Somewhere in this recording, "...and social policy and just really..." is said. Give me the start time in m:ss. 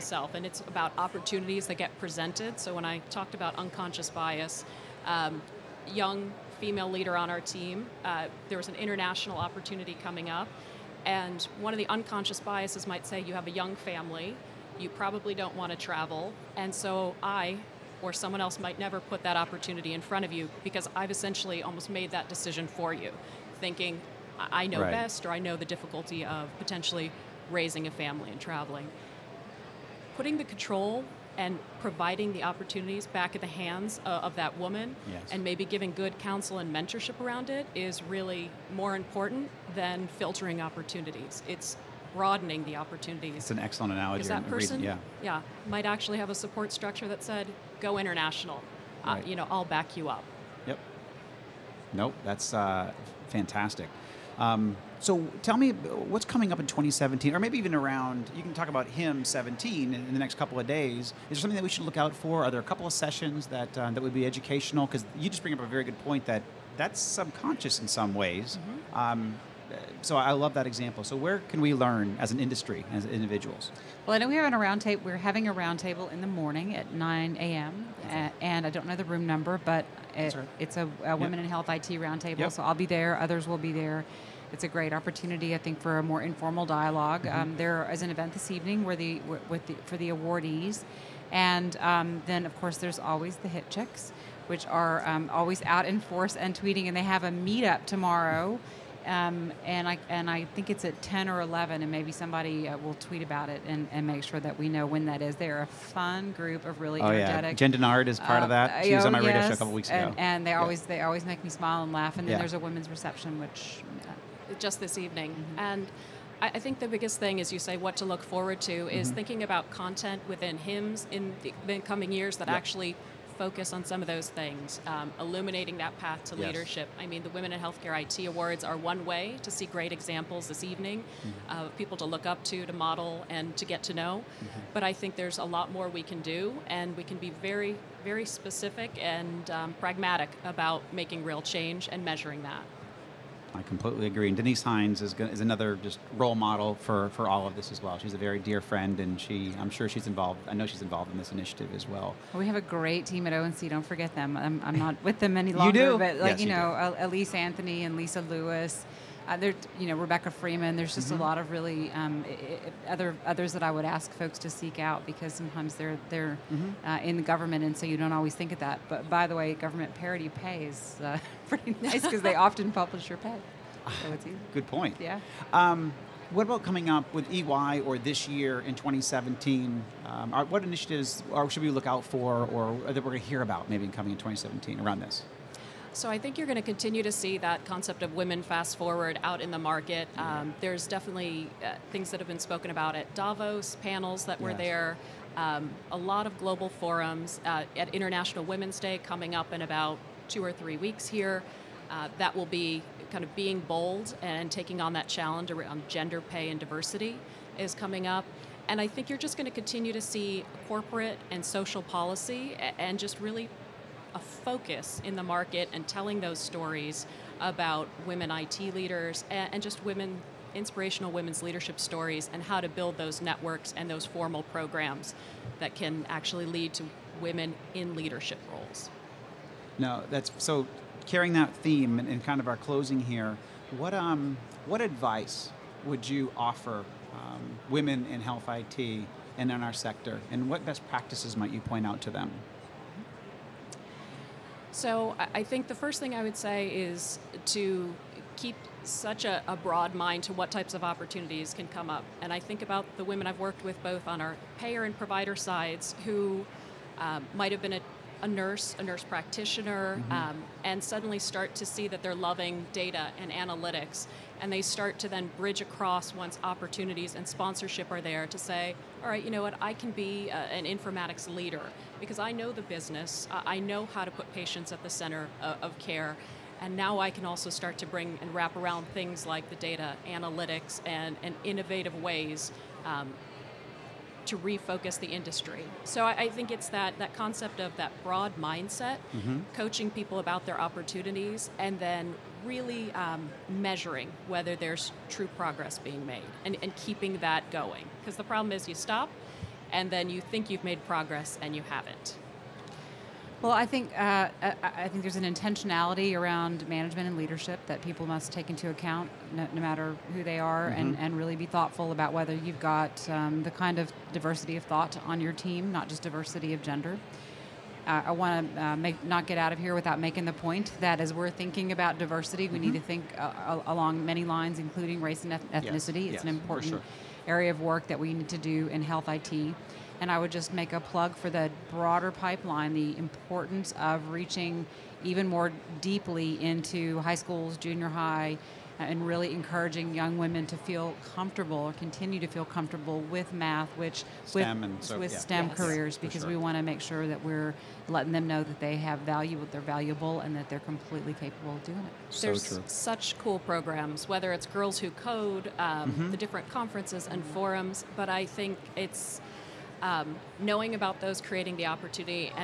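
3:31.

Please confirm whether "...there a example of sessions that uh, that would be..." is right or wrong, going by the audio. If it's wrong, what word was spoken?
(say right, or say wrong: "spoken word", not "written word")
wrong: "couple", not "example".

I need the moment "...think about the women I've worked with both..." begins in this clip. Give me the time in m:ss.
4:12.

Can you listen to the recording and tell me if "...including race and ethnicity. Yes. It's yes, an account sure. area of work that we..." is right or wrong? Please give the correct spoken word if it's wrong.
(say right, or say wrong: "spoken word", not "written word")
wrong: "important", not "account".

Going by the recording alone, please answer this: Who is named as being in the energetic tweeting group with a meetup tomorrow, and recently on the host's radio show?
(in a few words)
Jen Dennard.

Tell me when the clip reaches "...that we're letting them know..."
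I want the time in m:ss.
5:47.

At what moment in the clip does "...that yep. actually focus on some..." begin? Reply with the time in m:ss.
2:02.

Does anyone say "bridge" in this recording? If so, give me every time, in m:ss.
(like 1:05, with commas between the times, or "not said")
4:25.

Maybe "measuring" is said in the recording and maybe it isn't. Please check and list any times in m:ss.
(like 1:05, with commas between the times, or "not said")
2:22, 4:53.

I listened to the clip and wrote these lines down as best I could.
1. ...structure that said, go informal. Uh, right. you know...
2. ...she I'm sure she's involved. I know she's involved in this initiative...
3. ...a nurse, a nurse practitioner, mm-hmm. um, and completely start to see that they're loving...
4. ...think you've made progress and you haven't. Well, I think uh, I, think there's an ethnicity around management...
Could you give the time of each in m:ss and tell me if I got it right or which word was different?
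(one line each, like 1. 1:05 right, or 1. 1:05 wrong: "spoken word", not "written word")
1. 0:46 wrong: "international", not "informal"
2. 2:29 right
3. 4:18 wrong: "suddenly", not "completely"
4. 5:00 wrong: "intentionality", not "ethnicity".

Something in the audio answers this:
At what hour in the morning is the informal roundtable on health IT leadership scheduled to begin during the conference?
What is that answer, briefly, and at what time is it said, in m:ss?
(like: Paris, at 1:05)
9 a.m., at 1:16.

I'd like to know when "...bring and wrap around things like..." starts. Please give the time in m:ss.
4:37.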